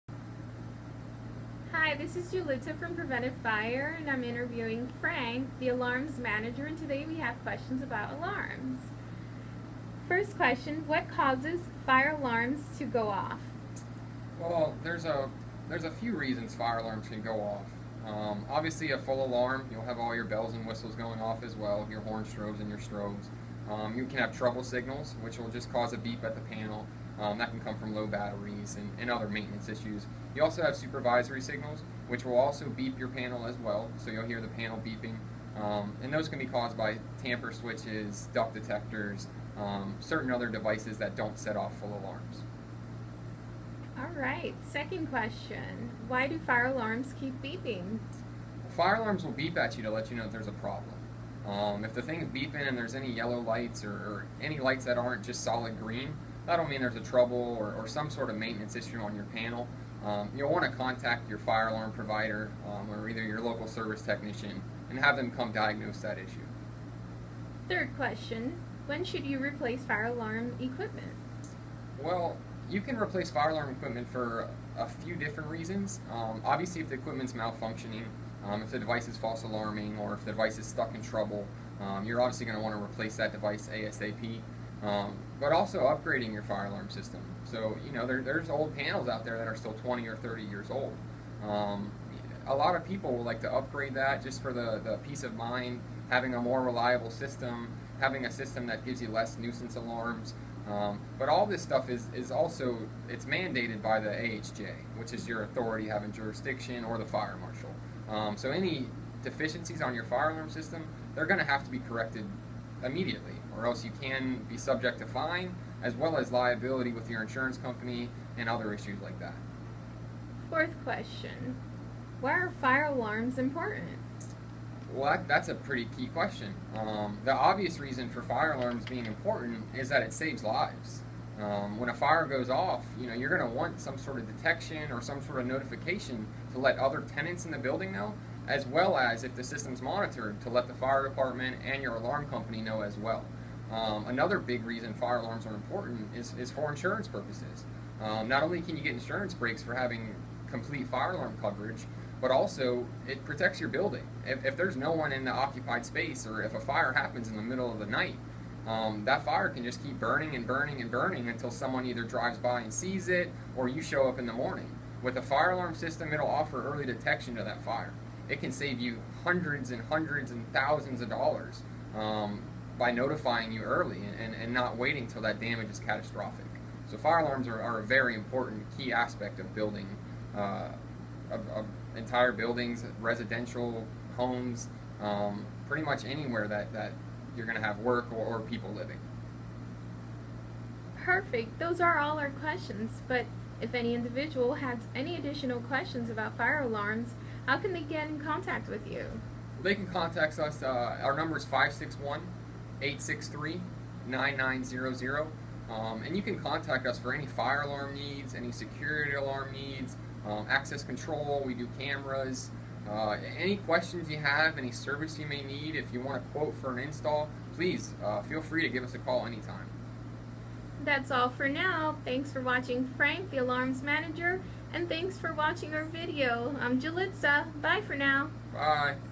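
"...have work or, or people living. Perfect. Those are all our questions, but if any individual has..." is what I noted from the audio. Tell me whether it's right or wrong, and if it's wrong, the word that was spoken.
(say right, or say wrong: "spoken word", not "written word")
right.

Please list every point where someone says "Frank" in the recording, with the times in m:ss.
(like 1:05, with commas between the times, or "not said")
0:05, 3:42.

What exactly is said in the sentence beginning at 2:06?
Um, the obvious reason for fire alarms being important is that it saves lives.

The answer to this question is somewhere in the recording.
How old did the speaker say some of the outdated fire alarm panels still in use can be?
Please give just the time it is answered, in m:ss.
1:29.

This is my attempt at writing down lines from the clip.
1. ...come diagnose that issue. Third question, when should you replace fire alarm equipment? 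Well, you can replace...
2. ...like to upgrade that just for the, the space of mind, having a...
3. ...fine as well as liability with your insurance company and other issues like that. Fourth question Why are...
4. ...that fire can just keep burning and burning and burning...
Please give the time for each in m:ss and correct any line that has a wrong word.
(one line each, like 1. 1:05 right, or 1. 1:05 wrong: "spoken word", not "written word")
1. 1:05 right
2. 1:33 wrong: "peace", not "space"
3. 1:55 right
4. 2:39 right.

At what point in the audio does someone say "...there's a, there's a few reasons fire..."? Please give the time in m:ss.
0:14.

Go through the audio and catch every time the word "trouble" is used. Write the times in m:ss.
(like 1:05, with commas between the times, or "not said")
0:24, 0:56, 1:21.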